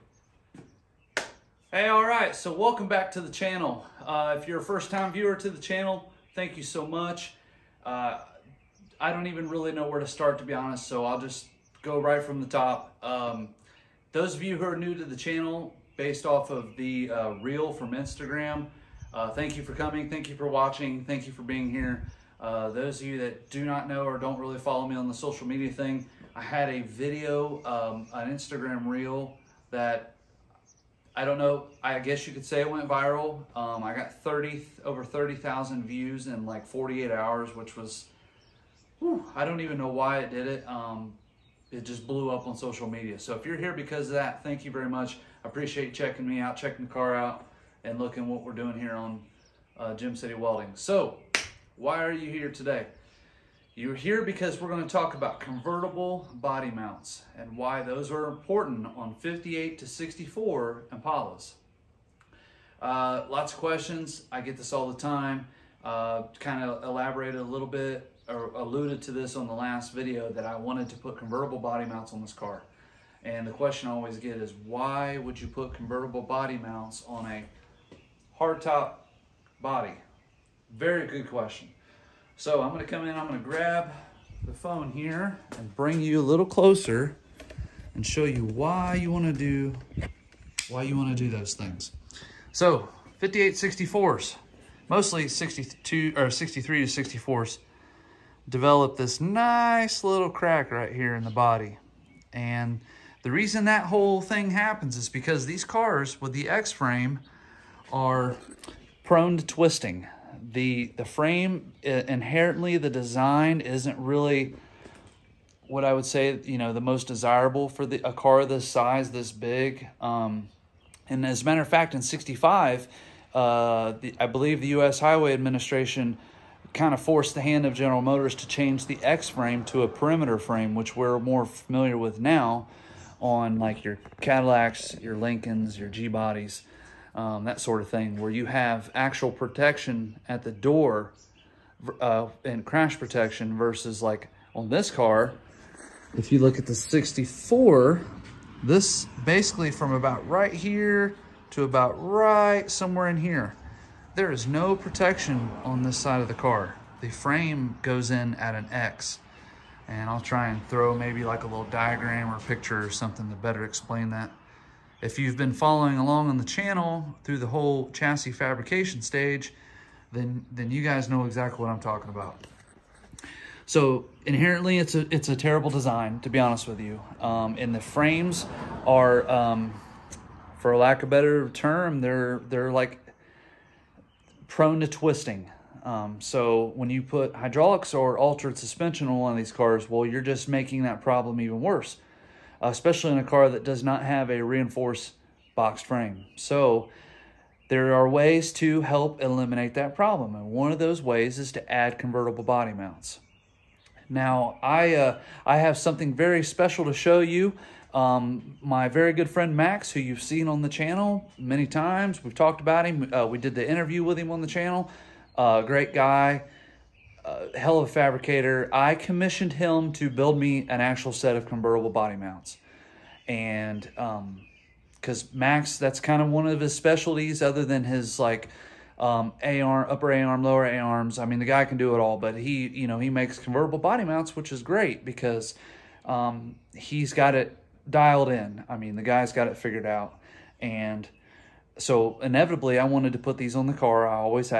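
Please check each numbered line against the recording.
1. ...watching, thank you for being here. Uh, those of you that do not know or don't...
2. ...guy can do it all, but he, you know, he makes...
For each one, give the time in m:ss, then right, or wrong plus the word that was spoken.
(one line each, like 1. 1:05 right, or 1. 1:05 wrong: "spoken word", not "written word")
1. 0:20 right
2. 3:51 right.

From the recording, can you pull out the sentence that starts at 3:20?
And one of those ways is to add convertible body mounts.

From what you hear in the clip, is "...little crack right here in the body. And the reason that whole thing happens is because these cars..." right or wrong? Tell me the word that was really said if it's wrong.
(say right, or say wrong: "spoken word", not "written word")
right.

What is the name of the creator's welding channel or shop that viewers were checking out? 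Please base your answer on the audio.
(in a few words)
Gem City Welding.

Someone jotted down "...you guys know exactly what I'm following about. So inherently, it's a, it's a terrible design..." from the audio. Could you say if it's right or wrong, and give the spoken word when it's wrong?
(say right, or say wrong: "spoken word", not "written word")
wrong: "talking", not "following".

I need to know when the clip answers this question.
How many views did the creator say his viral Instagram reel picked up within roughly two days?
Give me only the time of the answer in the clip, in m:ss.
0:34.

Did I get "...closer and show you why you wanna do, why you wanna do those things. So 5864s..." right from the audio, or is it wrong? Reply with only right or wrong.
right.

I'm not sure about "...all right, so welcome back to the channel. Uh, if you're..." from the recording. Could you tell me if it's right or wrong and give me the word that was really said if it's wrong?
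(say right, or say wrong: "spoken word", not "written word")
right.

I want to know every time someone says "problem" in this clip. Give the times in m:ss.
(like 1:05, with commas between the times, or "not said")
3:11, 3:19.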